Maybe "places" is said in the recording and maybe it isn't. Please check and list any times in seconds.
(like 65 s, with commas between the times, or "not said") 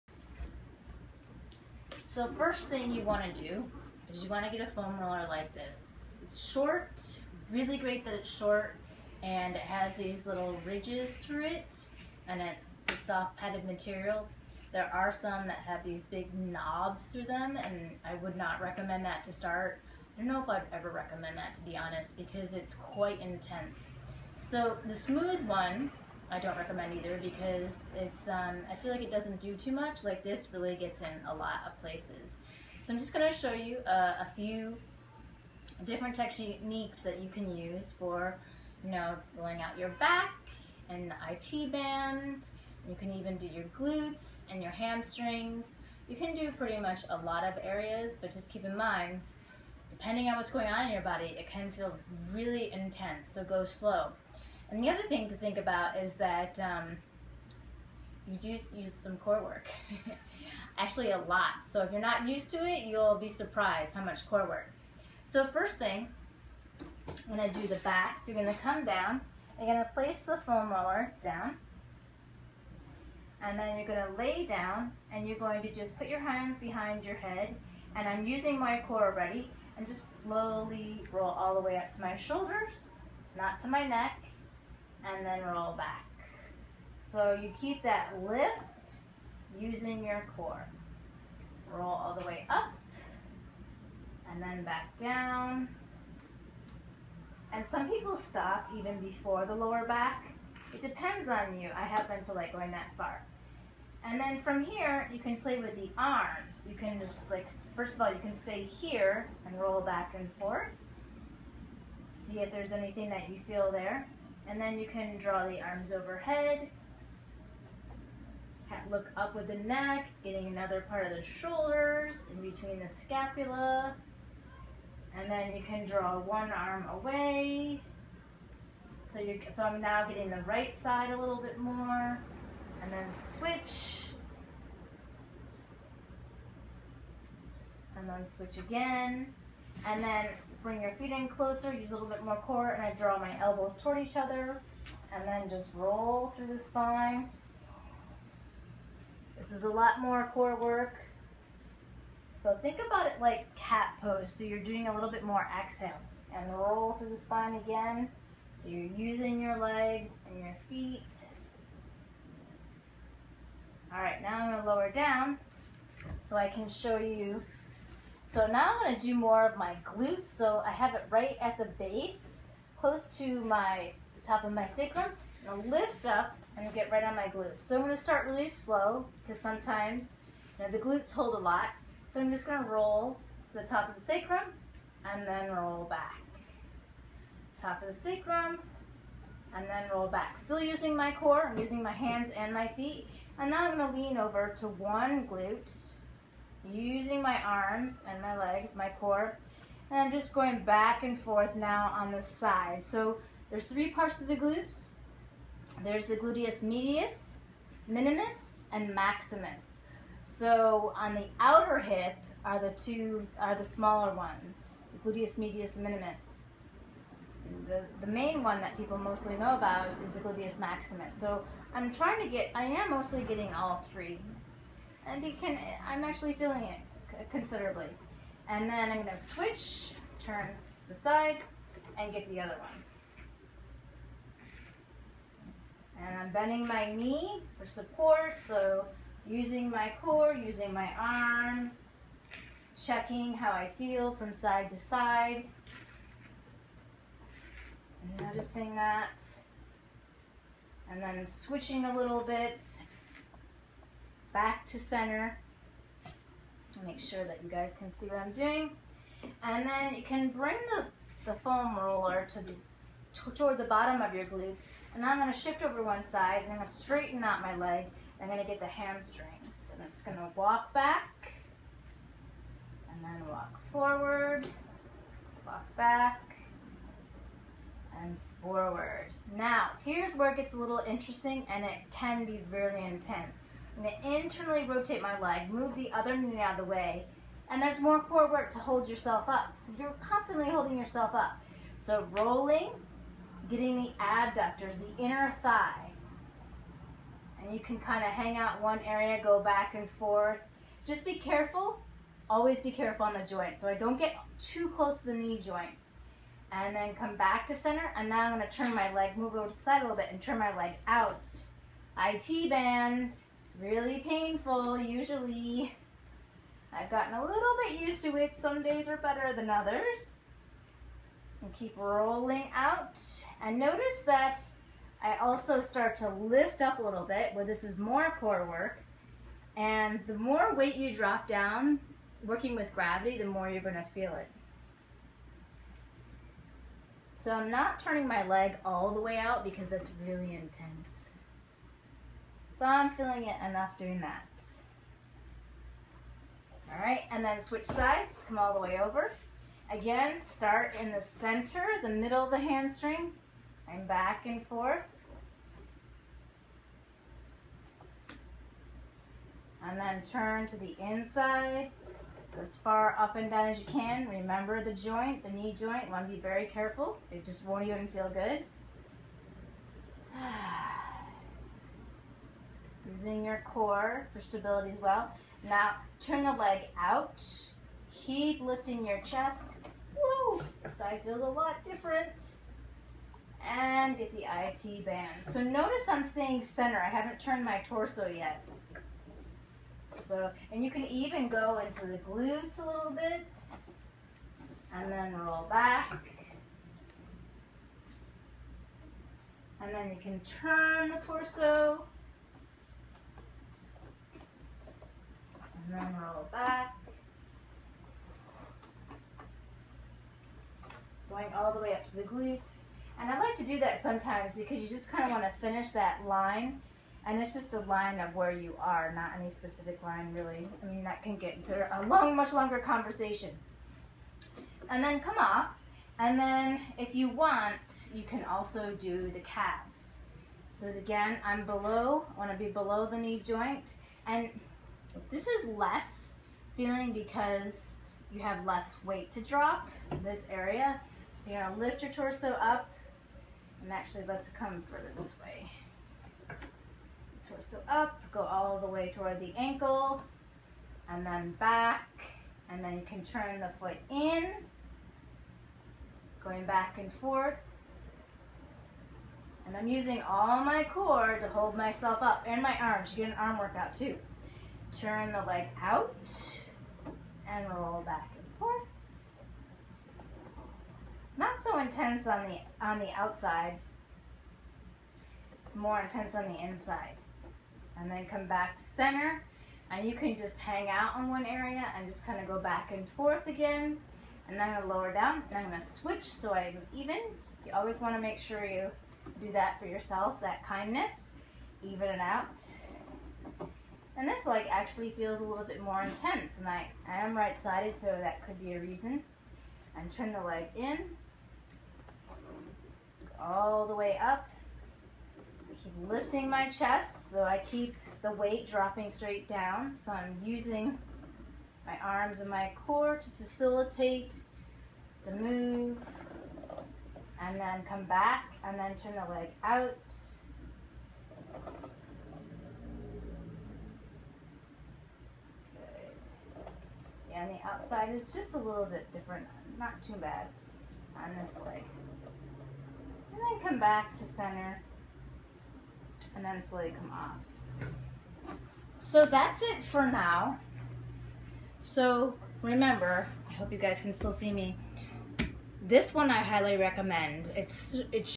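31 s, 69 s.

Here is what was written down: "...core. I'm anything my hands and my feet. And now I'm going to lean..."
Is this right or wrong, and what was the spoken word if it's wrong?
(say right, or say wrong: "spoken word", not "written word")
wrong: "using", not "anything".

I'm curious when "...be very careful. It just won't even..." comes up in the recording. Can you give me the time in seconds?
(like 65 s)
366 s.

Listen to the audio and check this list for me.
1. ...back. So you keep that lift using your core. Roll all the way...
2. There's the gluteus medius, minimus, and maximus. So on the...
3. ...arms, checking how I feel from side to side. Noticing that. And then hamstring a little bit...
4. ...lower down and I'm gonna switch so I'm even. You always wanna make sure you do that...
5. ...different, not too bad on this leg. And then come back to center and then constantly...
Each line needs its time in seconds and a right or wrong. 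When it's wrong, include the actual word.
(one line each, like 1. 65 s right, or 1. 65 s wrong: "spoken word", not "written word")
1. 85 s right
2. 205 s right
3. 240 s wrong: "switching", not "hamstring"
4. 484 s right
5. 528 s wrong: "slowly", not "constantly".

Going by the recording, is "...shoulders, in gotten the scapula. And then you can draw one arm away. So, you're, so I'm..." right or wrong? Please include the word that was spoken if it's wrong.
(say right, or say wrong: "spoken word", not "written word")
wrong: "between", not "gotten".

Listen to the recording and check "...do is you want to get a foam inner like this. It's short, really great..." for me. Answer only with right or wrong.
wrong.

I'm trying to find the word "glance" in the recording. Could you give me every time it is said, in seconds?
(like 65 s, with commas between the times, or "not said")
not said.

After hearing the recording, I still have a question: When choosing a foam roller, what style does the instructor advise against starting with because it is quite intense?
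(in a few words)
big knobs.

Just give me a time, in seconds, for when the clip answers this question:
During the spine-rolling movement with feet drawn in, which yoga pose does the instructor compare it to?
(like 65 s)
153 s.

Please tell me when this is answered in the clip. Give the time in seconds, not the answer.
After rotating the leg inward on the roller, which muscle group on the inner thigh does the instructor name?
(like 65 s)
294 s.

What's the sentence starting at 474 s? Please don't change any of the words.
It's more intense on the inside.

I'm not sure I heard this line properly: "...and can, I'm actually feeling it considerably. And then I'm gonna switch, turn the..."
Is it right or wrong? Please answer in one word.
right.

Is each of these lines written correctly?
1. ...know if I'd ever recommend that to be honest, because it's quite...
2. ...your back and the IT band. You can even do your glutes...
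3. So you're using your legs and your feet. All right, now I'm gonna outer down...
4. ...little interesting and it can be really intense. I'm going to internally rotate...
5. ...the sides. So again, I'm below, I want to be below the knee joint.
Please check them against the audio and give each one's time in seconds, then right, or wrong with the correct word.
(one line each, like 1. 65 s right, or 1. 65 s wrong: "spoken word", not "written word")
1. 20 s right
2. 39 s right
3. 158 s wrong: "lower", not "outer"
4. 280 s right
5. 429 s wrong: "calves", not "sides".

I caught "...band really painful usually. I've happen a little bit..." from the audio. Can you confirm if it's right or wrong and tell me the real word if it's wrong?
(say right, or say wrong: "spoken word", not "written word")
wrong: "gotten", not "happen".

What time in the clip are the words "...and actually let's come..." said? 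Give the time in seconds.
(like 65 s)
443 s.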